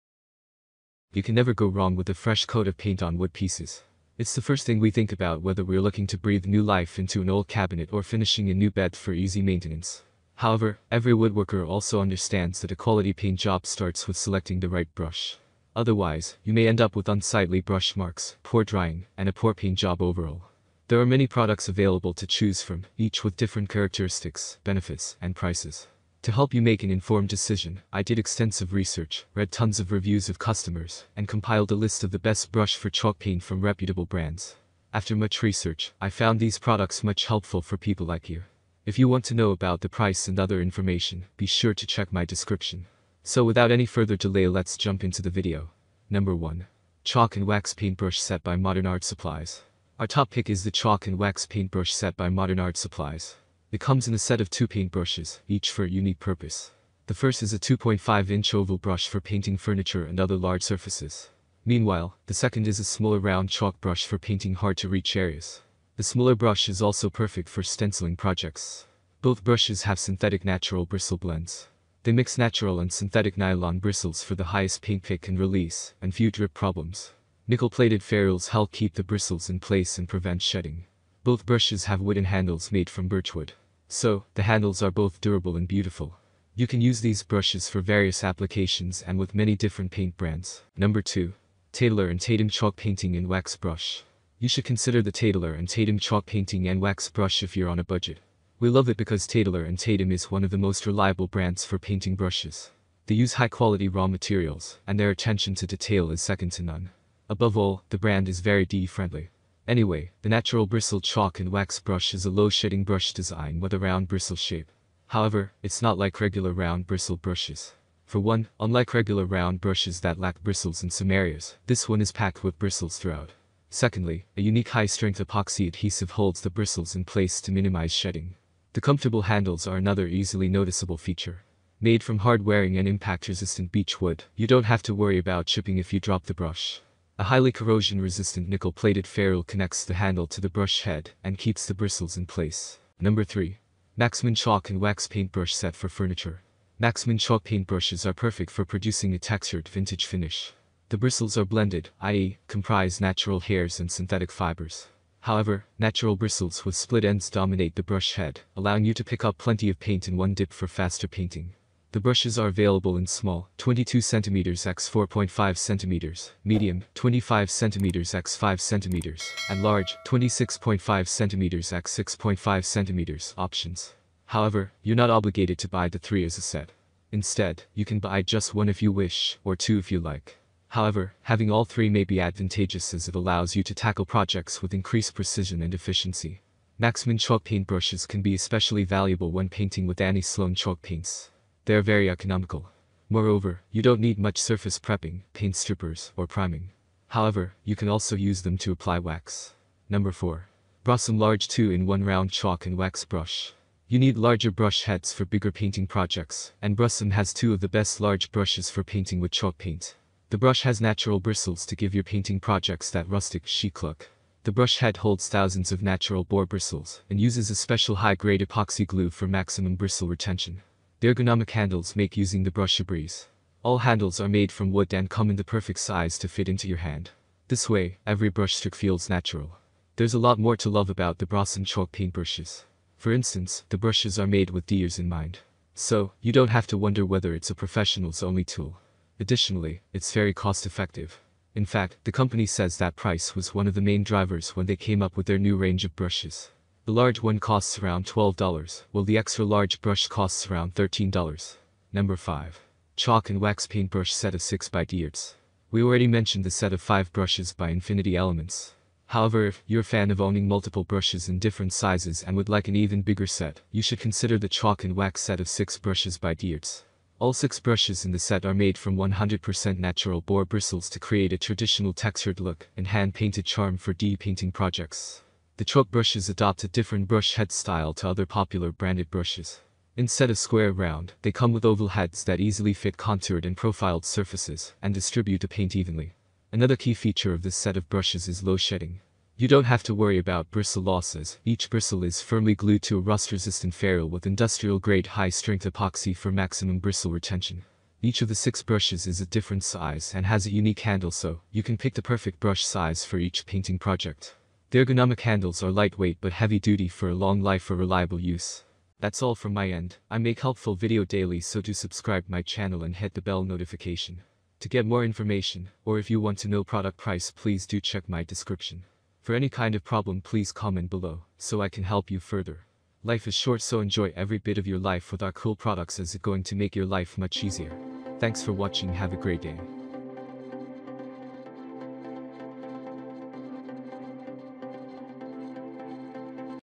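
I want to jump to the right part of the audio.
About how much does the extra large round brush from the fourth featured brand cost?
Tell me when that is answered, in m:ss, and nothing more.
4:10.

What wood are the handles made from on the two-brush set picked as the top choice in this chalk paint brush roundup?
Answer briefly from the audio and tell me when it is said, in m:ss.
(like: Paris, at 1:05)
birchwood, at 1:23.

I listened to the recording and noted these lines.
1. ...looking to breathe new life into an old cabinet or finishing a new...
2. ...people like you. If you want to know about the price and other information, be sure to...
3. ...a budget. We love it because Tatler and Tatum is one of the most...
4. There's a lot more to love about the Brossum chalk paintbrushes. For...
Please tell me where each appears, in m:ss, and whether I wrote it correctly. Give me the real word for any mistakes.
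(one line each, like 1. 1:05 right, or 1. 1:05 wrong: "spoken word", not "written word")
1. 0:05 right
2. 0:37 right
3. 1:37 right
4. 3:49 right.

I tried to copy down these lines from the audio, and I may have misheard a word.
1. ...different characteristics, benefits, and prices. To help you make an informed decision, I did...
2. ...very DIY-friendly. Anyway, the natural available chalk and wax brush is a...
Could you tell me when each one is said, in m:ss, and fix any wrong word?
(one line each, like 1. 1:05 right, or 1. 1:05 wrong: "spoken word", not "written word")
1. 0:23 right
2. 1:48 wrong: "bristle", not "available".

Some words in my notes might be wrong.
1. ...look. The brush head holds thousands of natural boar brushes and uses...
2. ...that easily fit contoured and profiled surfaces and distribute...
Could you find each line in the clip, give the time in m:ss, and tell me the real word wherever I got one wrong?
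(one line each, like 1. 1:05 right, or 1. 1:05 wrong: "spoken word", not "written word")
1. 3:33 wrong: "bristles", not "brushes"
2. 4:42 right.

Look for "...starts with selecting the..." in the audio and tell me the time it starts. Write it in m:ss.
0:13.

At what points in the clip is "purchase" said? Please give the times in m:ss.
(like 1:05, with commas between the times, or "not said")
not said.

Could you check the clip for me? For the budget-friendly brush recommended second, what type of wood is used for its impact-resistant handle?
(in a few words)
beech wood.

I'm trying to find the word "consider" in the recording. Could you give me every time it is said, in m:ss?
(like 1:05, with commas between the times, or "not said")
1:34, 4:23.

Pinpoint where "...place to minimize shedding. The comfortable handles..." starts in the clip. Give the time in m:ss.
2:07.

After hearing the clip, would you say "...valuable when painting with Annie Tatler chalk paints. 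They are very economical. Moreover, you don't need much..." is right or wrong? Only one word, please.
wrong.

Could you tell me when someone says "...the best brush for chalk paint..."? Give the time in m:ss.
0:32.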